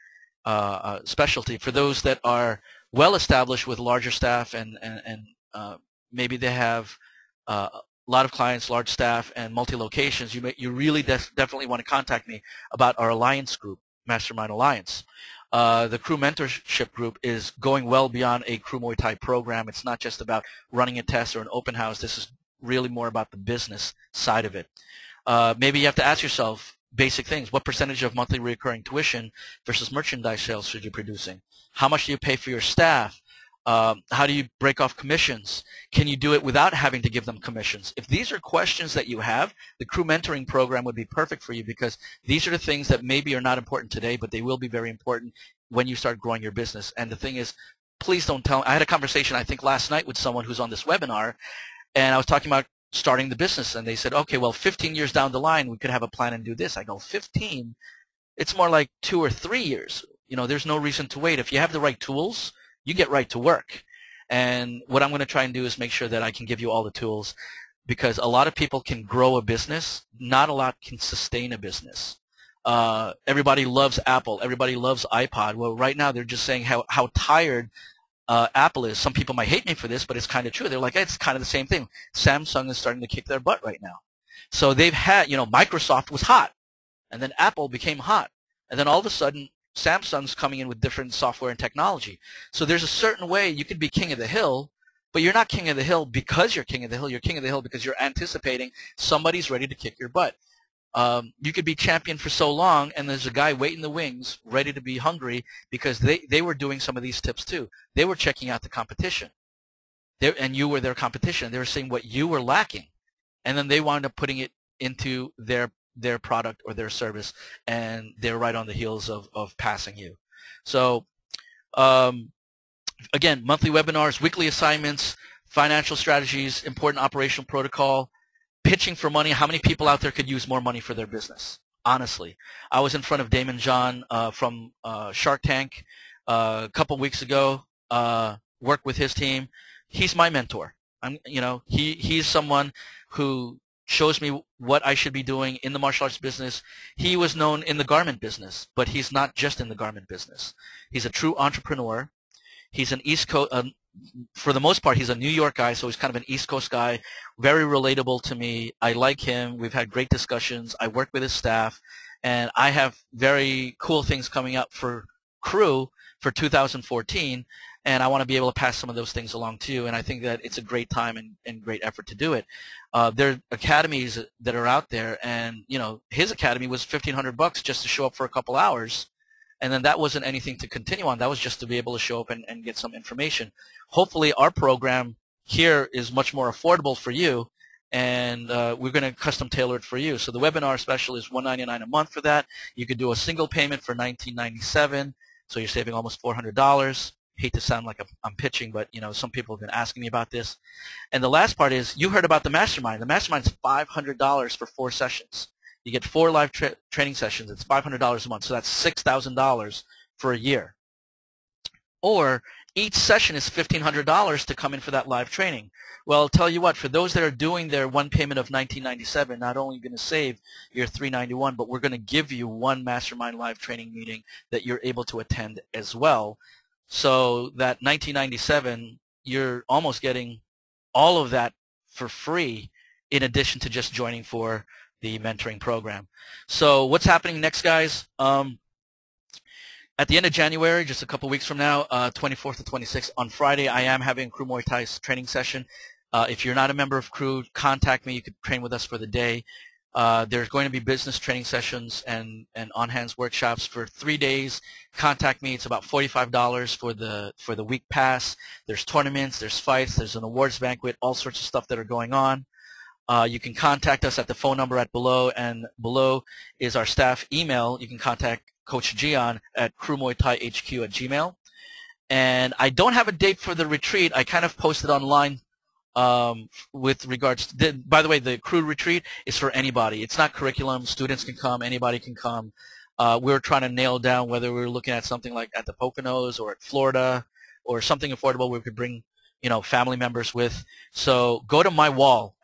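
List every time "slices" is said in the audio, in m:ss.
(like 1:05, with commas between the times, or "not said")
not said.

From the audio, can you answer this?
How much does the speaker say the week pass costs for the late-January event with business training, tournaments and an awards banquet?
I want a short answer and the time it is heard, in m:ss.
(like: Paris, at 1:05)
$45, at 4:15.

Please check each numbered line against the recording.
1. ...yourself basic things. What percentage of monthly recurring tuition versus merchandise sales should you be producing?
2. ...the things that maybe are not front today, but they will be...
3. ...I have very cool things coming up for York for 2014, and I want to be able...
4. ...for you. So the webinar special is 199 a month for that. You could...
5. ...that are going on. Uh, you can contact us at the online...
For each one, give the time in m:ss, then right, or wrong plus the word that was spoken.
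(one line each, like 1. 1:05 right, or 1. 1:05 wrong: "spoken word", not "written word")
1. 0:26 right
2. 0:42 wrong: "important", not "front"
3. 2:42 wrong: "KRU", not "York"
4. 3:09 right
5. 4:21 wrong: "phone", not "online".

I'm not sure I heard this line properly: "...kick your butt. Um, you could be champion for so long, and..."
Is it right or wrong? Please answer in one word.
right.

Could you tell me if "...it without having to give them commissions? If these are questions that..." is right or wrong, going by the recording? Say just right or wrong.
right.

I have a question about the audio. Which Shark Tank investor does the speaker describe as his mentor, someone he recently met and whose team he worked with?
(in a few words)
Daymond John.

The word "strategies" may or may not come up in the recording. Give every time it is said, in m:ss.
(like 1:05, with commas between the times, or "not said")
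2:05.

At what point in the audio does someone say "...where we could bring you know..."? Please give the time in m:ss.
4:48.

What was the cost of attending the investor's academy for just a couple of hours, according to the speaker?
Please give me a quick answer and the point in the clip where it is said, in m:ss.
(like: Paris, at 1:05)
$1,500, at 2:56.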